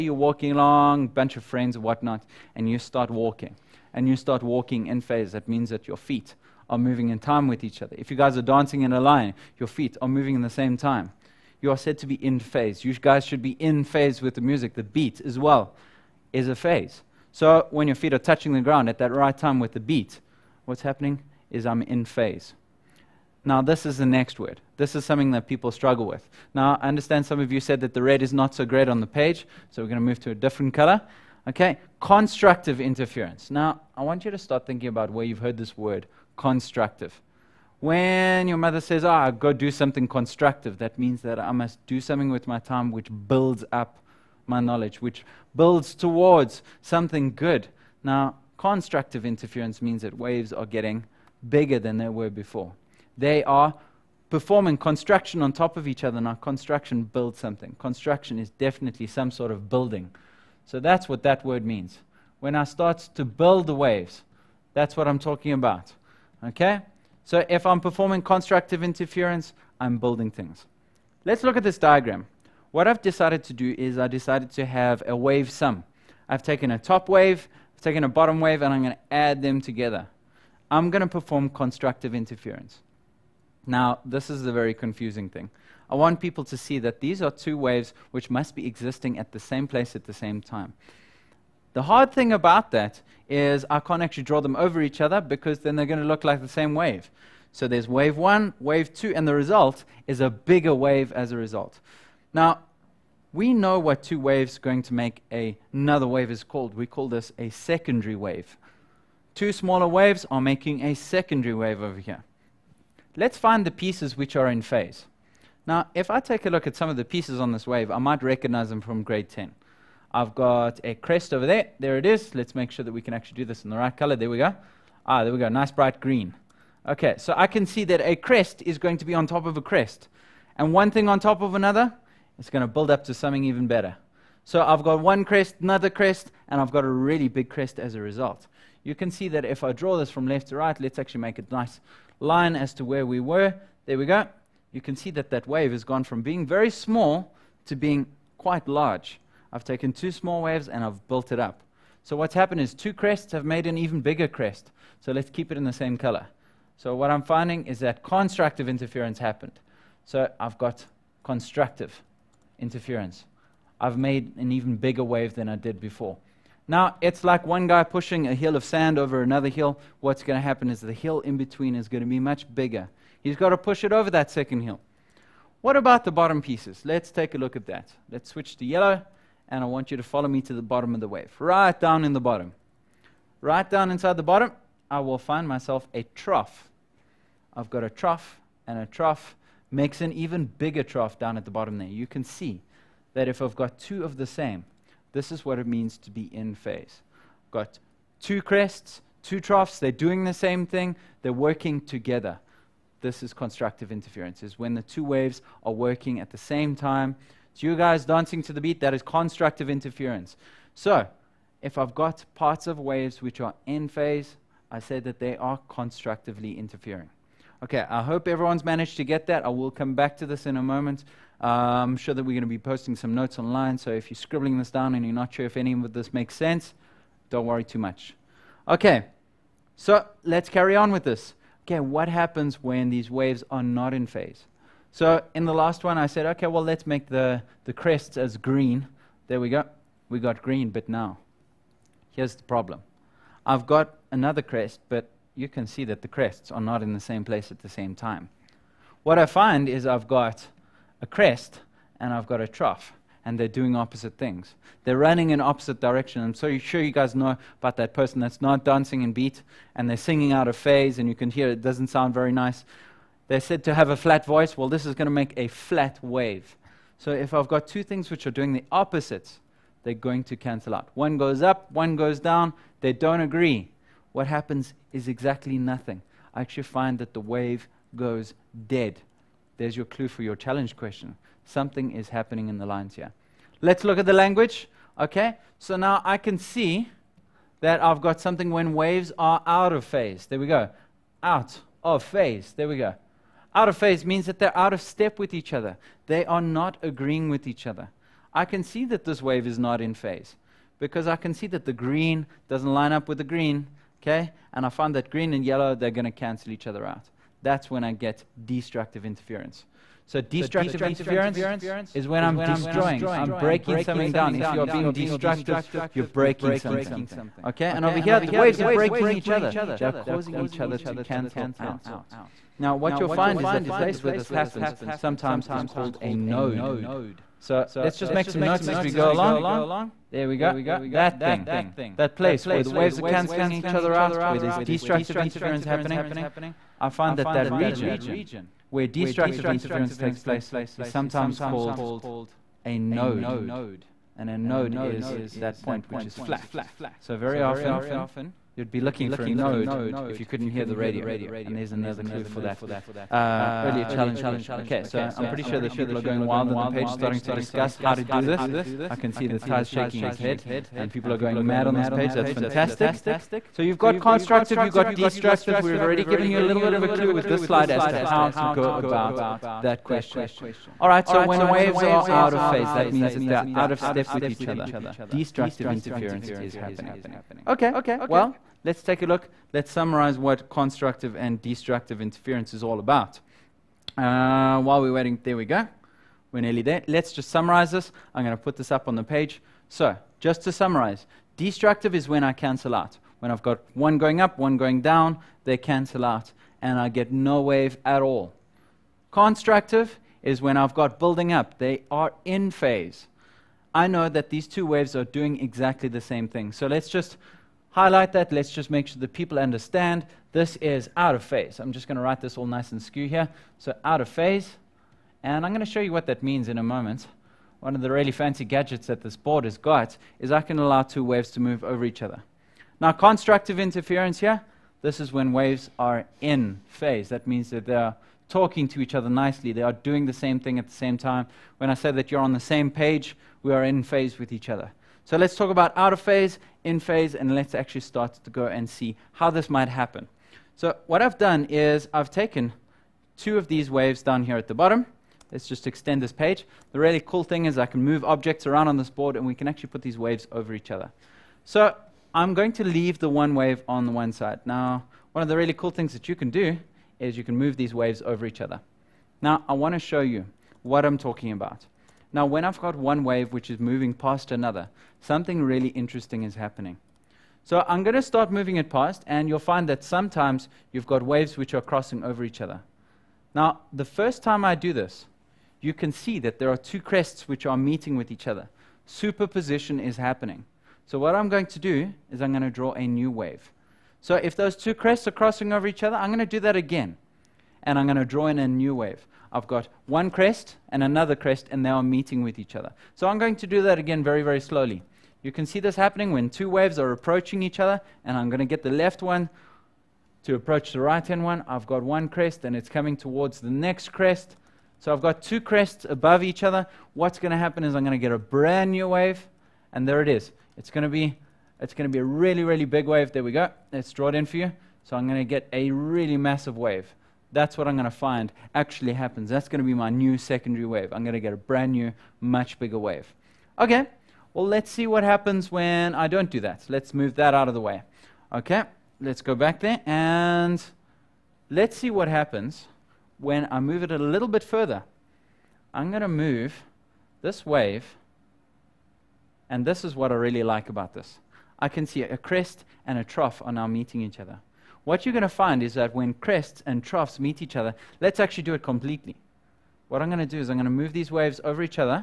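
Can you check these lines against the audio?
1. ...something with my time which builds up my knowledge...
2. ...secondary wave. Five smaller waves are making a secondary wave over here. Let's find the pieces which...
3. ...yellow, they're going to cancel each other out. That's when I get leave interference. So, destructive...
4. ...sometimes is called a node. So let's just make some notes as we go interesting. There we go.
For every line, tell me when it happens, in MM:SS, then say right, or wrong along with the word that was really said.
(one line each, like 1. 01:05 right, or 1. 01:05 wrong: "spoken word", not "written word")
1. 00:42 right
2. 01:47 wrong: "Two", not "Five"
3. 05:05 wrong: "destructive", not "leave"
4. 05:24 wrong: "along", not "interesting".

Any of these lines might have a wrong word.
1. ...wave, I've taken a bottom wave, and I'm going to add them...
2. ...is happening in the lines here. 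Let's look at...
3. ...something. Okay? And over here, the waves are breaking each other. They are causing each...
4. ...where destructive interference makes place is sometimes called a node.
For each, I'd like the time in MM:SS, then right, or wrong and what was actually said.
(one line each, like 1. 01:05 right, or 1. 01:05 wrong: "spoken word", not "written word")
1. 01:17 right
2. 04:41 right
3. 05:16 right
4. 05:38 wrong: "takes", not "makes".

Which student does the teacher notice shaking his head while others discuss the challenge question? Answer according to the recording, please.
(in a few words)
Ty.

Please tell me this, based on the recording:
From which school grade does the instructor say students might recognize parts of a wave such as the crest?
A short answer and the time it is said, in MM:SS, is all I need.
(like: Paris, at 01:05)
grade 10, at 01:59.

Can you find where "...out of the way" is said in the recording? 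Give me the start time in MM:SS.
08:47.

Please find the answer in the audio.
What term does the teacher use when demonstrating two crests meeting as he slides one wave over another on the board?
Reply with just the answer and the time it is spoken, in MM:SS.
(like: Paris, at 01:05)
superposition, at 07:58.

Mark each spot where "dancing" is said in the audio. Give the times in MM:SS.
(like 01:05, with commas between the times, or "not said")
00:08, 03:28, 04:18.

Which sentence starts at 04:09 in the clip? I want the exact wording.
What I find is I've got a crest and I've got a trough, and they're doing opposite things.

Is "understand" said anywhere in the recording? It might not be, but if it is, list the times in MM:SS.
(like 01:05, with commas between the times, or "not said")
00:26, 06:49.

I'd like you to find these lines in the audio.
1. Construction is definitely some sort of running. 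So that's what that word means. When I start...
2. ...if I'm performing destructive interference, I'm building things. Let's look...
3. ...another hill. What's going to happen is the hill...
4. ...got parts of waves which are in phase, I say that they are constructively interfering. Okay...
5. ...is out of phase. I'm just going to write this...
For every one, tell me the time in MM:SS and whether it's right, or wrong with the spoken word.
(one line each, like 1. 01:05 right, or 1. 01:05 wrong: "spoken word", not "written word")
1. 00:57 wrong: "building", not "running"
2. 01:07 wrong: "constructive", not "destructive"
3. 02:49 right
4. 03:31 right
5. 06:50 right.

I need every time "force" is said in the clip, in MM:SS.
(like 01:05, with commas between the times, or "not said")
not said.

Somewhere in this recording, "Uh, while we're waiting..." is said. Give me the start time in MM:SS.
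06:23.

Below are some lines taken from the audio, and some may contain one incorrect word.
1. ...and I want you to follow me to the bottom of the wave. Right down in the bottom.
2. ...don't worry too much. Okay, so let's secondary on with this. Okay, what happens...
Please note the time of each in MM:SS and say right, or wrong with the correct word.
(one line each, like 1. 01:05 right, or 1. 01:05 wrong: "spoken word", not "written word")
1. 02:59 right
2. 03:47 wrong: "carry", not "secondary".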